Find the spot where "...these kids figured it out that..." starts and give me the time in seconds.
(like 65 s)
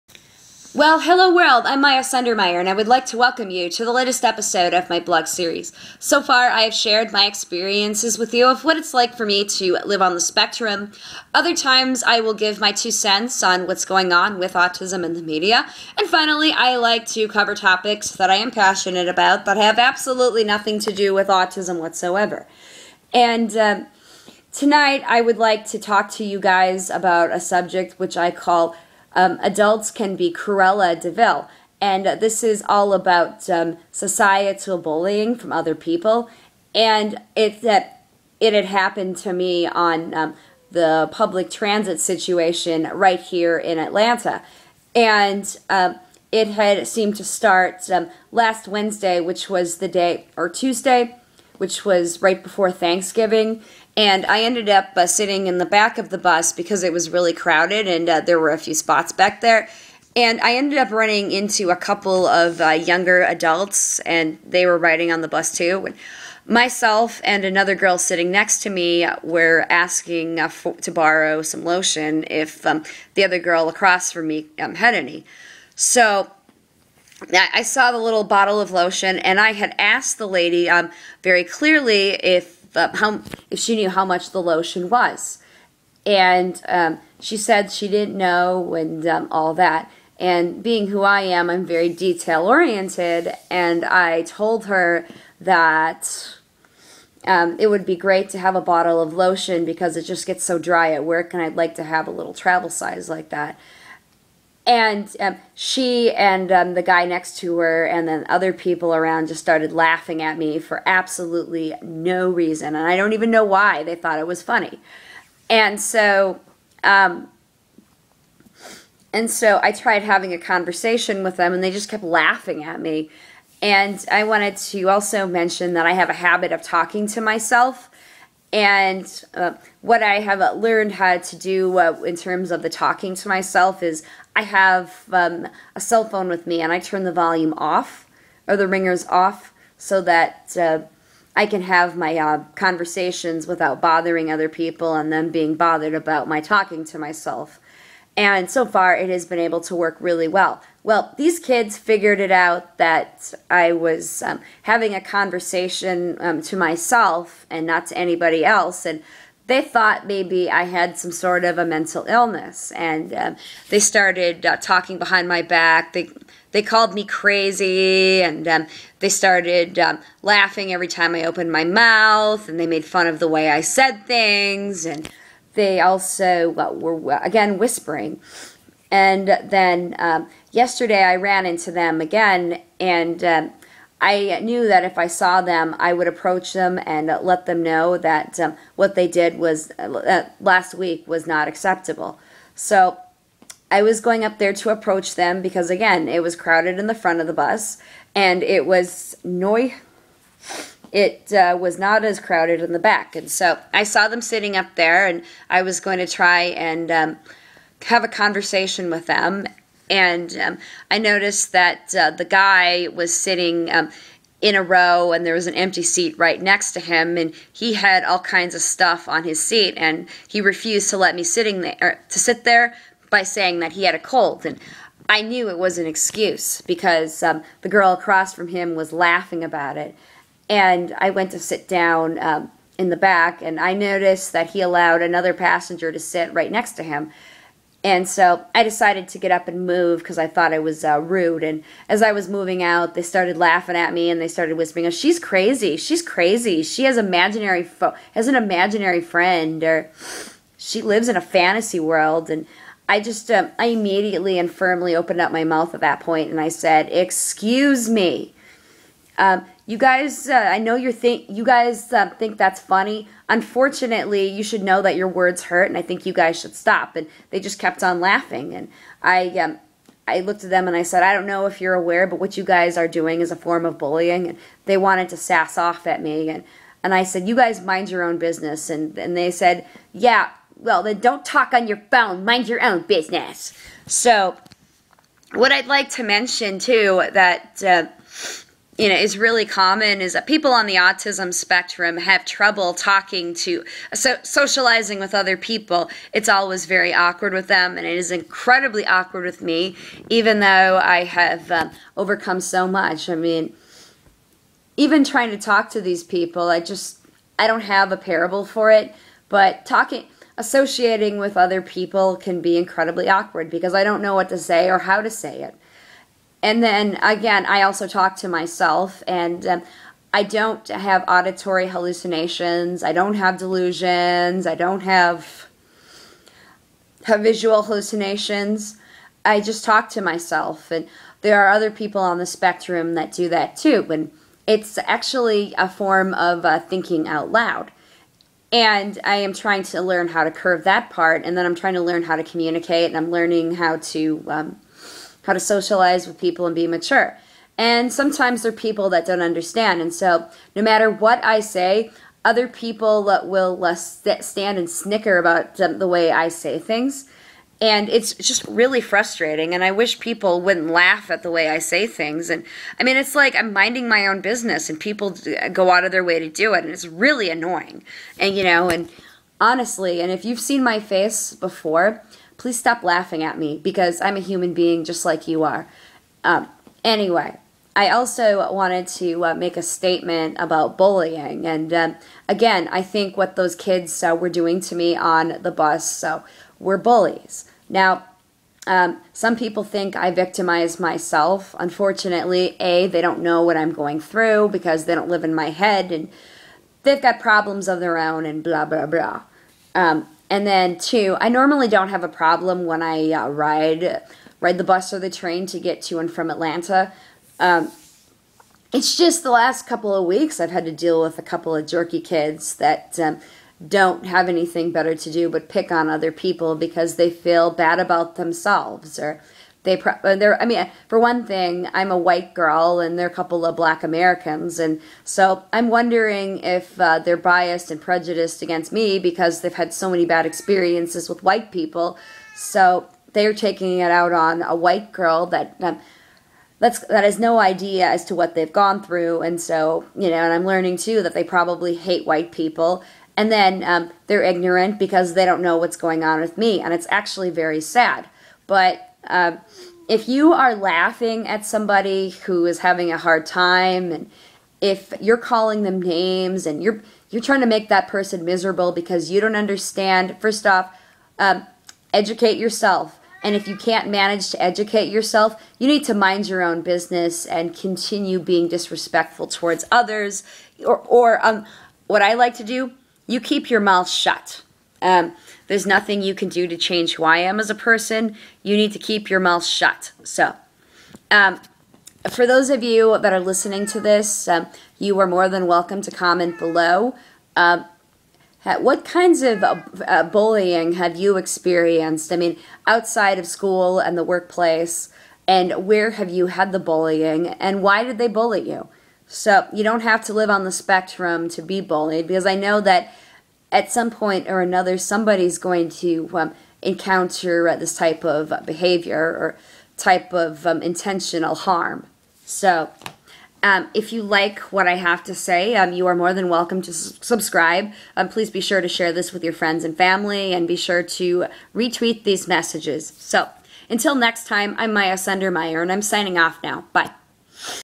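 151 s.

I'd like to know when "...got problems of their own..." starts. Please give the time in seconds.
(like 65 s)
397 s.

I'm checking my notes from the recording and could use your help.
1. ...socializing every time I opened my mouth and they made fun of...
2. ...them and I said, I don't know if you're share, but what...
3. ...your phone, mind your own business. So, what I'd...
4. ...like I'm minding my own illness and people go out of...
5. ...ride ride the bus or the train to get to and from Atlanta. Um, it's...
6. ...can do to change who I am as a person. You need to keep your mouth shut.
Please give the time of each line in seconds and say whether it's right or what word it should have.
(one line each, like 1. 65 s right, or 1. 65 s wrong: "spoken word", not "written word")
1. 170 s wrong: "laughing", not "socializing"
2. 270 s wrong: "aware", not "share"
3. 281 s right
4. 363 s wrong: "business", not "illness"
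5. 403 s right
6. 476 s right.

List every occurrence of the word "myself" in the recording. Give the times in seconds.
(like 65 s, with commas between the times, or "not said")
66 s, 127 s, 133 s, 146 s, 156 s, 318 s, 330 s, 390 s.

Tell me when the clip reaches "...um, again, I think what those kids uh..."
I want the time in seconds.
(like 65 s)
381 s.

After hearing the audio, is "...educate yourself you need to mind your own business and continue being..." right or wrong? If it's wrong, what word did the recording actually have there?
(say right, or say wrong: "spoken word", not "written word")
right.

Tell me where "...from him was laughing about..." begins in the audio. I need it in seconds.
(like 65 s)
228 s.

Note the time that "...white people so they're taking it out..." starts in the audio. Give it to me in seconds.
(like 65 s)
431 s.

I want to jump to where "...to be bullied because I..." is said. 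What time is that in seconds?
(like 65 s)
501 s.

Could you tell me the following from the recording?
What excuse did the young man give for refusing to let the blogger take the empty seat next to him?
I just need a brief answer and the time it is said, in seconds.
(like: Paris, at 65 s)
He had a cold, at 223 s.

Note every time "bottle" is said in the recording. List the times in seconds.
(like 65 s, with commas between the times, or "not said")
78 s, 98 s.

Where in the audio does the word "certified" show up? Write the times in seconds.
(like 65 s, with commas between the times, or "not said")
not said.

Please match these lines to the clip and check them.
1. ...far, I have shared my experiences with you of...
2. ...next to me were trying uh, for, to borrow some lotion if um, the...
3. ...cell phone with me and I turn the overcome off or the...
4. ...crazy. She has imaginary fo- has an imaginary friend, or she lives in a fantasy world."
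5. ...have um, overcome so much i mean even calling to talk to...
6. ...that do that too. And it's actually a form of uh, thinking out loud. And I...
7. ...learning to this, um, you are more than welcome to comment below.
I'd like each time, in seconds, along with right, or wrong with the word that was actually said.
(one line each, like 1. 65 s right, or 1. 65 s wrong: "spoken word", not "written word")
1. 6 s right
2. 68 s wrong: "asking", not "trying"
3. 135 s wrong: "volume", not "overcome"
4. 246 s right
5. 301 s wrong: "trying", not "calling"
6. 332 s right
7. 483 s wrong: "listening", not "learning".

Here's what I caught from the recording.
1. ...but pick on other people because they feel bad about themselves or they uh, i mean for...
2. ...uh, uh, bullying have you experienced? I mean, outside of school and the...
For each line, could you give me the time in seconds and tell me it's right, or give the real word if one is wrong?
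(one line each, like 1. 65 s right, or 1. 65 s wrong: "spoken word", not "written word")
1. 415 s right
2. 489 s right.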